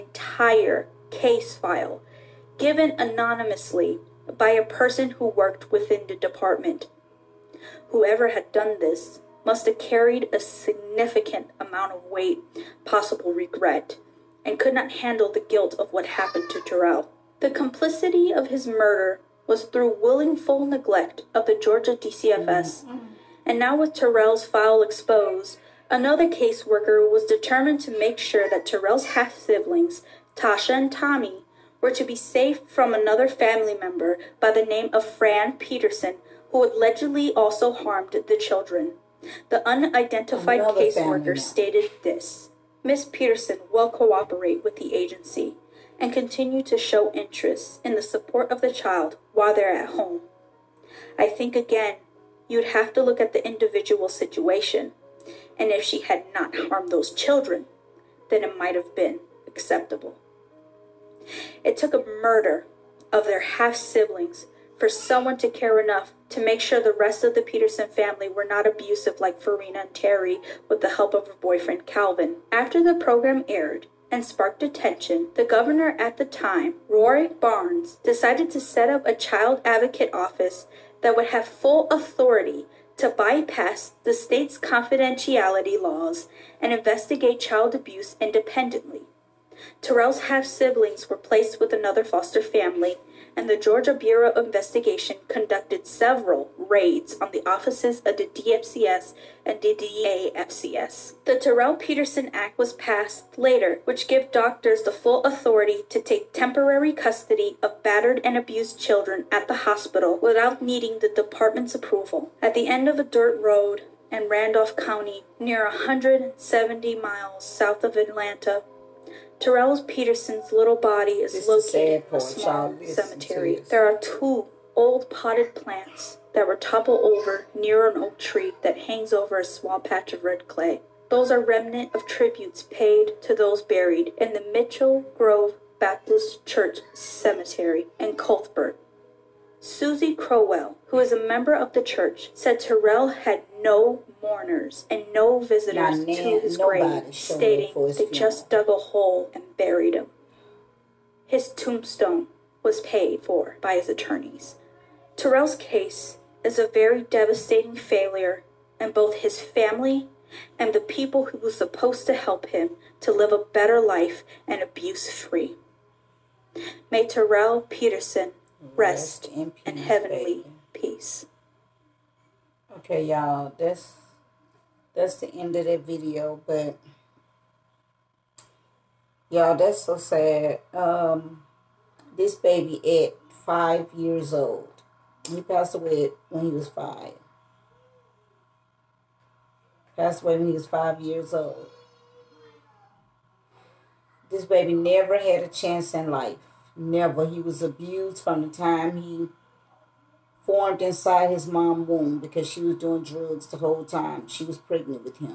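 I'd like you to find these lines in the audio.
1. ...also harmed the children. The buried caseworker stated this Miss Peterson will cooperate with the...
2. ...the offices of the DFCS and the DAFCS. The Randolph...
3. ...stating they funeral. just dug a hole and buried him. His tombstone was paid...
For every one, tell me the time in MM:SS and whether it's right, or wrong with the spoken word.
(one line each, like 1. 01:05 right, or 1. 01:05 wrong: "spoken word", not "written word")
1. 00:37 wrong: "unidentified", not "buried"
2. 01:37 wrong: "Terrell", not "Randolph"
3. 02:27 right.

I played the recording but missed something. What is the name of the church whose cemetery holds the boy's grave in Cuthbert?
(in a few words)
Mitchell Grove Baptist Church.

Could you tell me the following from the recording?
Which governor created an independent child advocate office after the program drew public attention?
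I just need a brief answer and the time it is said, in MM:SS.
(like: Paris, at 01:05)
Rory Barnes, at 01:16.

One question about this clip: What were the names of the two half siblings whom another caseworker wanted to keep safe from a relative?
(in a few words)
Tasha and Tommy.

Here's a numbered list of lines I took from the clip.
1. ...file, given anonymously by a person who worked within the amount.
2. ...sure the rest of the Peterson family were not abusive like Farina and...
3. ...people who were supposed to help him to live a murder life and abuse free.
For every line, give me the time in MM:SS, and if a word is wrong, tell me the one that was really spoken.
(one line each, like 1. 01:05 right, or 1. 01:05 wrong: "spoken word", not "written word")
1. 00:01 wrong: "department", not "amount"
2. 01:06 right
3. 02:40 wrong: "better", not "murder".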